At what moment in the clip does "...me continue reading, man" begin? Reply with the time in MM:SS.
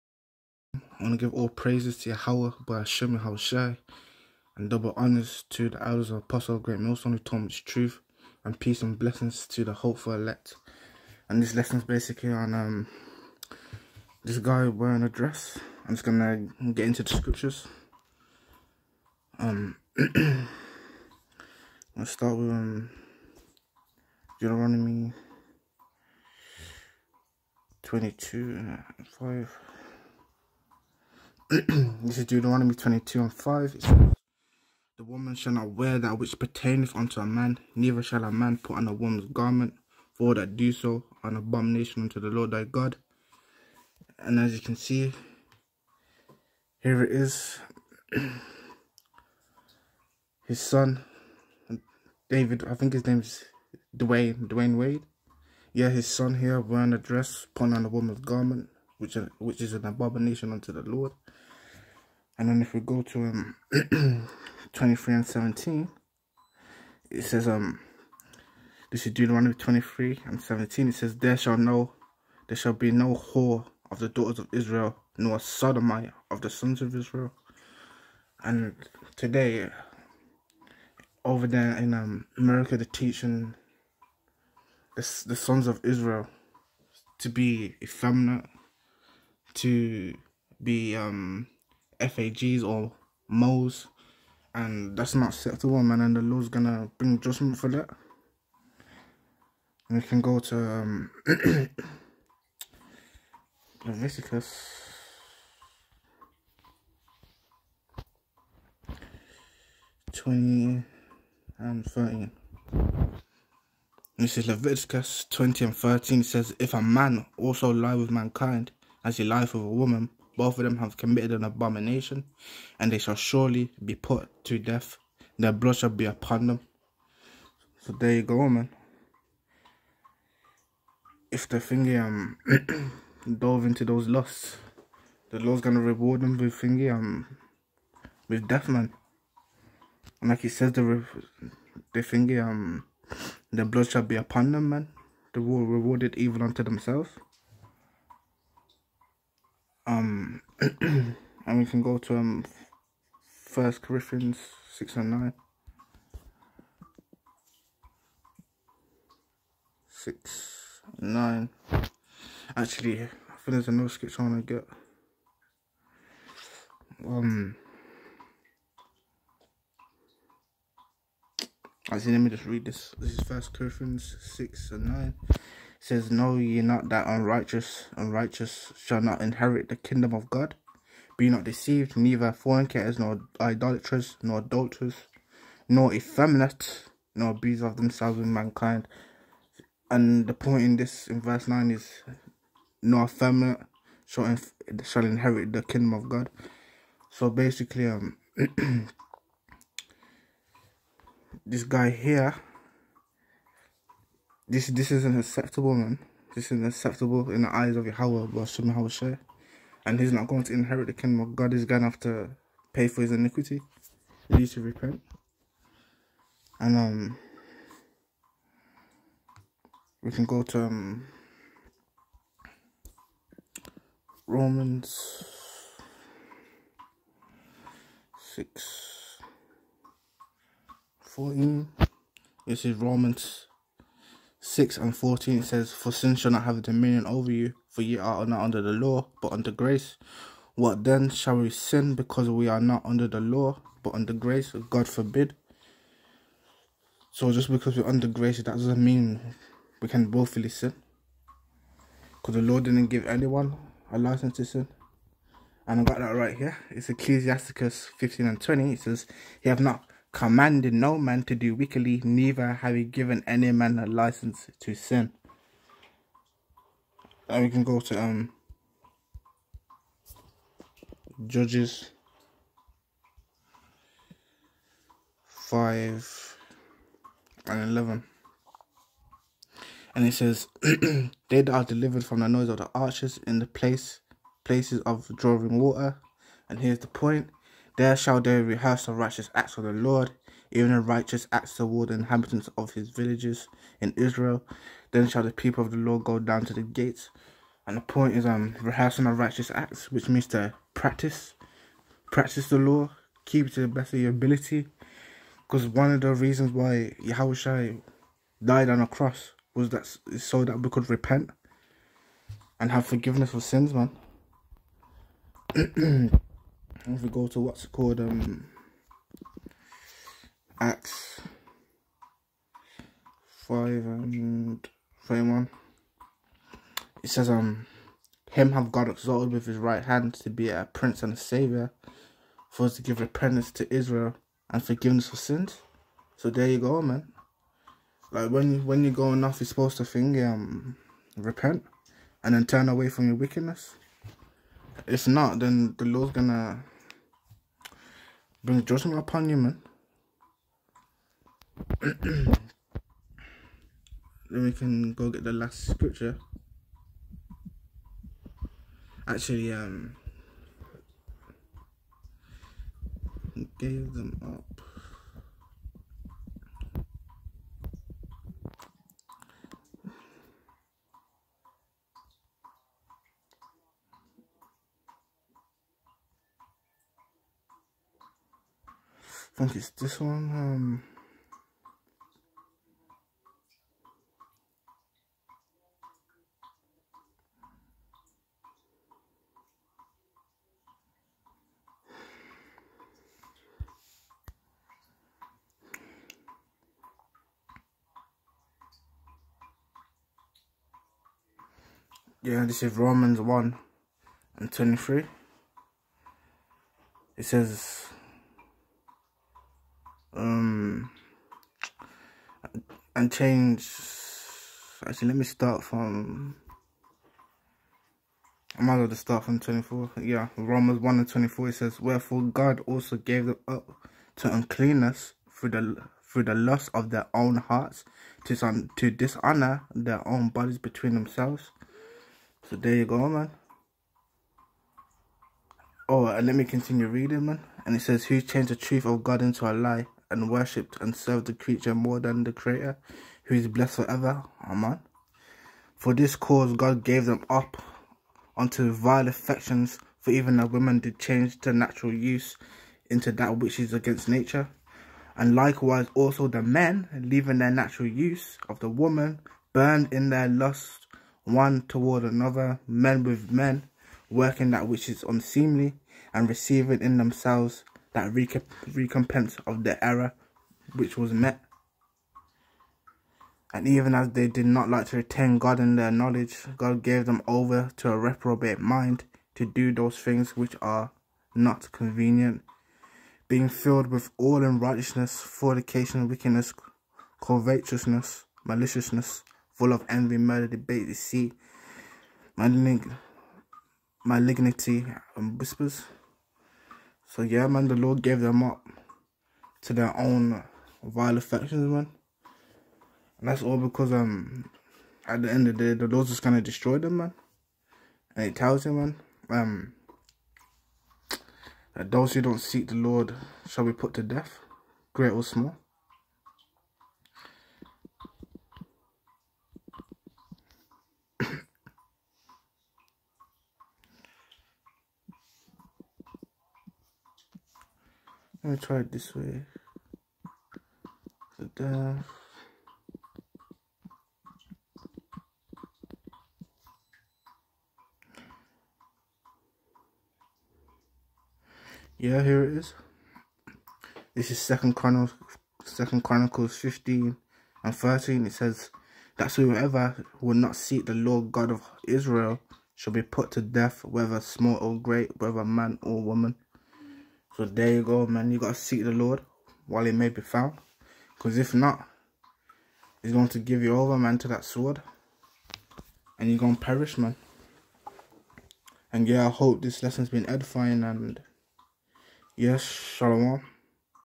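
07:16.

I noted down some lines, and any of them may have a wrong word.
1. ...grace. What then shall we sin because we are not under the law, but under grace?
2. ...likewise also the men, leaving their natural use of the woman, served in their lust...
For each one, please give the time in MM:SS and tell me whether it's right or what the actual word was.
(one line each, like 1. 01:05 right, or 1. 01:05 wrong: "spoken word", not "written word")
1. 03:59 right
2. 07:35 wrong: "burned", not "served".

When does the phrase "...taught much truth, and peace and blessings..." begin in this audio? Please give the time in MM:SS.
00:07.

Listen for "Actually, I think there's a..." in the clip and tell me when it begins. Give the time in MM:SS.
02:42.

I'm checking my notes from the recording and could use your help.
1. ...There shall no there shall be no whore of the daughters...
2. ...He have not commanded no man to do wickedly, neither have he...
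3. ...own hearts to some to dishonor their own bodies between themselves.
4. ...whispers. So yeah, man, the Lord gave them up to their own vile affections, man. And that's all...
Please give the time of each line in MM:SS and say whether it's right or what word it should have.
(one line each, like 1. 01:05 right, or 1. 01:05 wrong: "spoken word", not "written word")
1. 01:11 right
2. 04:19 right
3. 07:07 right
4. 08:15 right.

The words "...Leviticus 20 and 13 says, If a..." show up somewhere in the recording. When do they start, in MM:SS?
01:54.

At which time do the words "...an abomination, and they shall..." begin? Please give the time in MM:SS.
02:01.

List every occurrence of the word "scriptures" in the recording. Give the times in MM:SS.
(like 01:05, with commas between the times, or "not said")
00:17, 05:55.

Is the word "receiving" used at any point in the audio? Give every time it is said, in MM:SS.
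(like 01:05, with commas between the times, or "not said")
07:46.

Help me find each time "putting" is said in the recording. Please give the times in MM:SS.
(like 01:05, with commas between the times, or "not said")
00:57.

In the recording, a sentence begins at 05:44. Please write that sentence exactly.
If not, then the Lord's gonna bring judgment upon you, man.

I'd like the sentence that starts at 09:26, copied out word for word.
And you're going to perish, man.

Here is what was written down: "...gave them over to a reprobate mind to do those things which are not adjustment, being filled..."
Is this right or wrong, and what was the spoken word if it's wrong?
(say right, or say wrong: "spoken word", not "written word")
wrong: "convenient", not "adjustment".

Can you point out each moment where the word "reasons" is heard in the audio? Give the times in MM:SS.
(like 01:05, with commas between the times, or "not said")
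05:06.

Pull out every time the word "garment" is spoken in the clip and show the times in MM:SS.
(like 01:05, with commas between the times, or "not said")
00:39, 00:58.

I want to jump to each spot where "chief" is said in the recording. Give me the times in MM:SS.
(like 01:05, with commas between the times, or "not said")
not said.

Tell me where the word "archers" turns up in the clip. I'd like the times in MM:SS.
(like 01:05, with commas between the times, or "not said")
04:42.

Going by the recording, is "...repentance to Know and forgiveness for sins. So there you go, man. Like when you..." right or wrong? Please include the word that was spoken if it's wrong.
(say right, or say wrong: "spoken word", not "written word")
wrong: "Israel", not "Know".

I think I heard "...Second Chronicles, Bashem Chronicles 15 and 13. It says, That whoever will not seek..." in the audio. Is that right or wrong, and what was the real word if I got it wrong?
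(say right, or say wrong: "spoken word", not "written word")
wrong: "Second", not "Bashem".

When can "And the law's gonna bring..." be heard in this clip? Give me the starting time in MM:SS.
01:36.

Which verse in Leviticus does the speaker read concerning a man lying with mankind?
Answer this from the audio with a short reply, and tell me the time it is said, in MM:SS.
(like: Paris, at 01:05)
Leviticus 20:13, at 01:50.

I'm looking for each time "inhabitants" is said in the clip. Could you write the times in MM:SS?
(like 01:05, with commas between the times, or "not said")
04:51.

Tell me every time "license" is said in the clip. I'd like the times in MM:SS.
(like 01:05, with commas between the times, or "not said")
04:13, 04:23.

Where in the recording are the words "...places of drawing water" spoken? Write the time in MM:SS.
04:44.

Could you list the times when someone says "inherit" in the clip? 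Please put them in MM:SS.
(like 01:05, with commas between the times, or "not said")
02:59, 03:15, 03:30.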